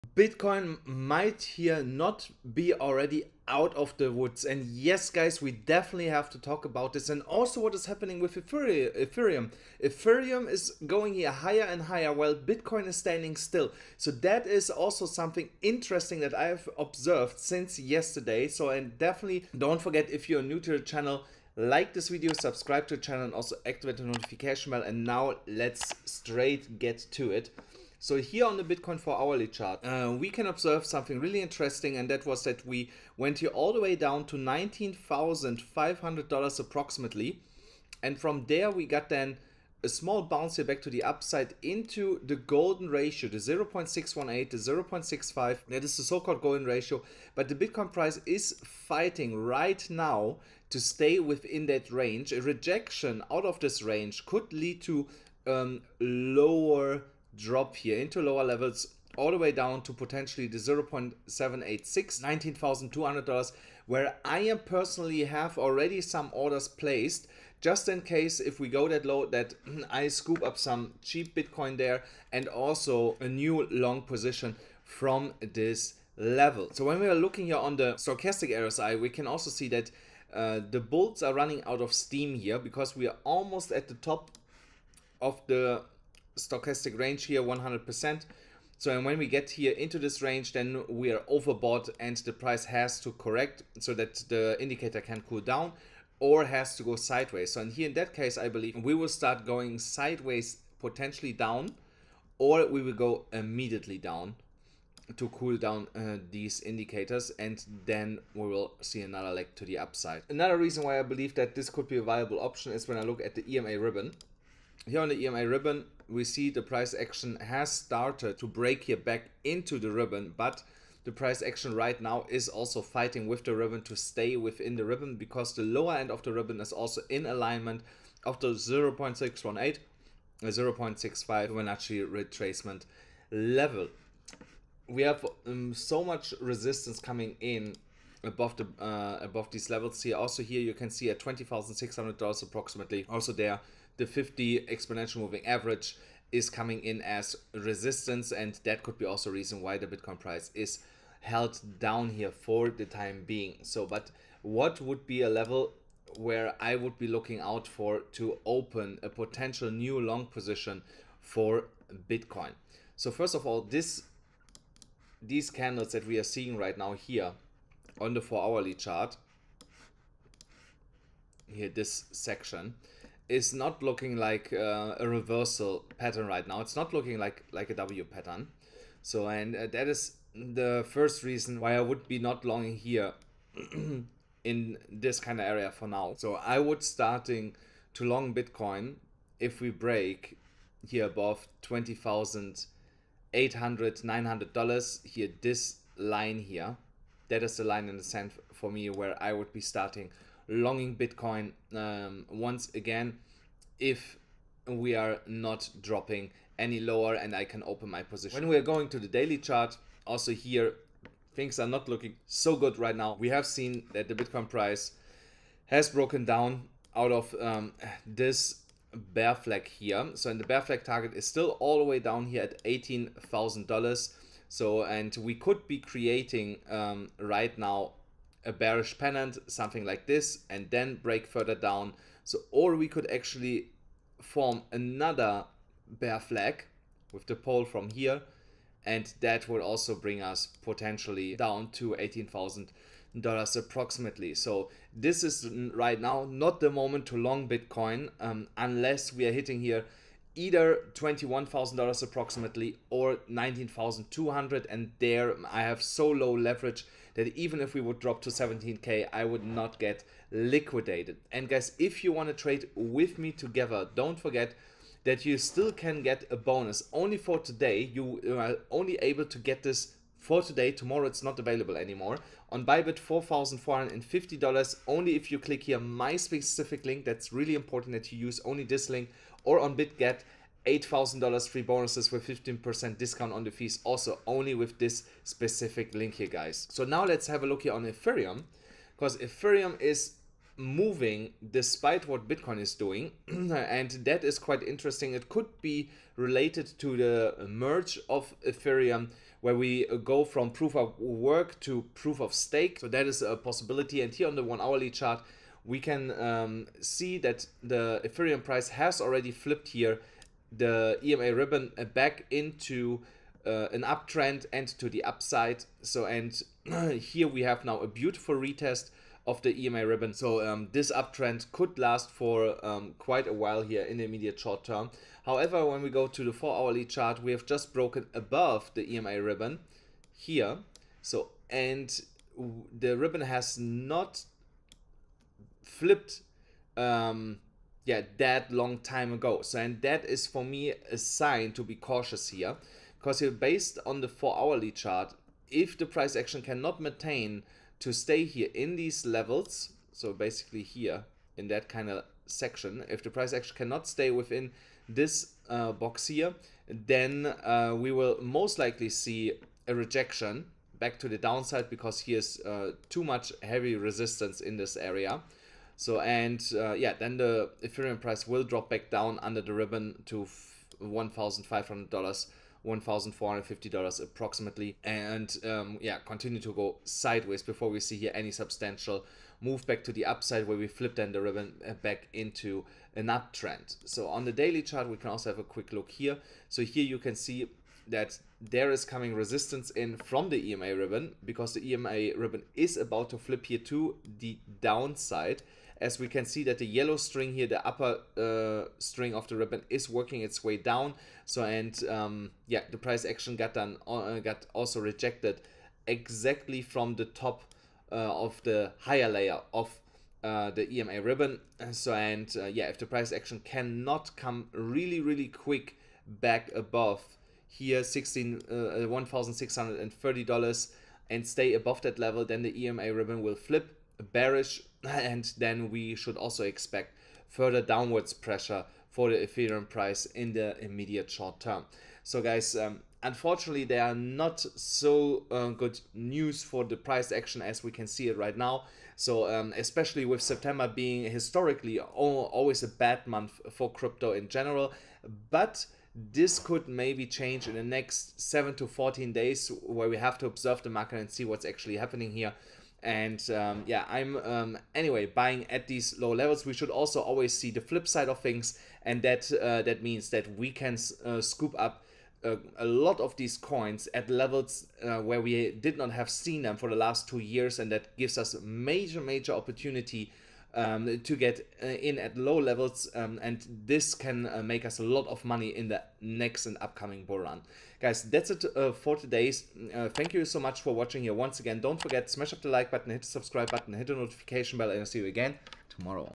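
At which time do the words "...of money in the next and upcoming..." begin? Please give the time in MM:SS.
07:55.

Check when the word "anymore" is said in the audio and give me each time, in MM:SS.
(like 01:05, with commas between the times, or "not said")
04:31.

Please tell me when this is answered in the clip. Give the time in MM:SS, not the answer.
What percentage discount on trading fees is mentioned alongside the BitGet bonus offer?
04:42.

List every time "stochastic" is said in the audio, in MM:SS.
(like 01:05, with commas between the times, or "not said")
01:17, 01:26.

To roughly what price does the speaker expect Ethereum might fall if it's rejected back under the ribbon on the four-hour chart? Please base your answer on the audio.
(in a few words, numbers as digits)
$1,450.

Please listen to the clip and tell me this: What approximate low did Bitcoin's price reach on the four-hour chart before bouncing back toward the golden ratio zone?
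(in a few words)
$19,500.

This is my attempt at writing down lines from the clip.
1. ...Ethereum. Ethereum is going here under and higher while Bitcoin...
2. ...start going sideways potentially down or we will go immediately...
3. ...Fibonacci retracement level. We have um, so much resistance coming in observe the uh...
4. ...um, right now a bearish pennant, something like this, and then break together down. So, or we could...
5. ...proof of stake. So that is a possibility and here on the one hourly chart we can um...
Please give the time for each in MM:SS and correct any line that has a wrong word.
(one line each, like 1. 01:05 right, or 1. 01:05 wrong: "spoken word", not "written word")
1. 00:08 wrong: "higher", not "under"
2. 01:39 right
3. 02:11 wrong: "above", not "observe"
4. 03:46 wrong: "further", not "together"
5. 05:01 right.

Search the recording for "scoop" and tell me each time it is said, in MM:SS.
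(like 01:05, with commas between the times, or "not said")
01:10, 07:41.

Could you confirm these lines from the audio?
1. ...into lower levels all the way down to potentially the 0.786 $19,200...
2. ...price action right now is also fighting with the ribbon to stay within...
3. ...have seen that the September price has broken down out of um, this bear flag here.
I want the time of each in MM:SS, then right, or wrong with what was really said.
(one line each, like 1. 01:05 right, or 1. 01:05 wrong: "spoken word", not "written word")
1. 00:57 right
2. 02:01 right
3. 03:33 wrong: "Bitcoin", not "September".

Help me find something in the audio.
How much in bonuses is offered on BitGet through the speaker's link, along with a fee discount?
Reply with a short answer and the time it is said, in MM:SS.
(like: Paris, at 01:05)
$8,000, at 04:40.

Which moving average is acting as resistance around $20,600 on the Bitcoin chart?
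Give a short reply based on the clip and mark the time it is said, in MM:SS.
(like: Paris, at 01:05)
50 exponential moving average, at 02:24.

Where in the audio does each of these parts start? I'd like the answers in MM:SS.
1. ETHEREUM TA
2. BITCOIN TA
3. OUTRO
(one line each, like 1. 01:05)
1. 04:47
2. 00:27
3. 07:22.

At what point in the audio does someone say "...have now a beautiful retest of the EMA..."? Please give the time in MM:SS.
05:17.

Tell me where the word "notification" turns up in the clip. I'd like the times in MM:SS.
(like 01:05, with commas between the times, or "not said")
00:24, 08:03.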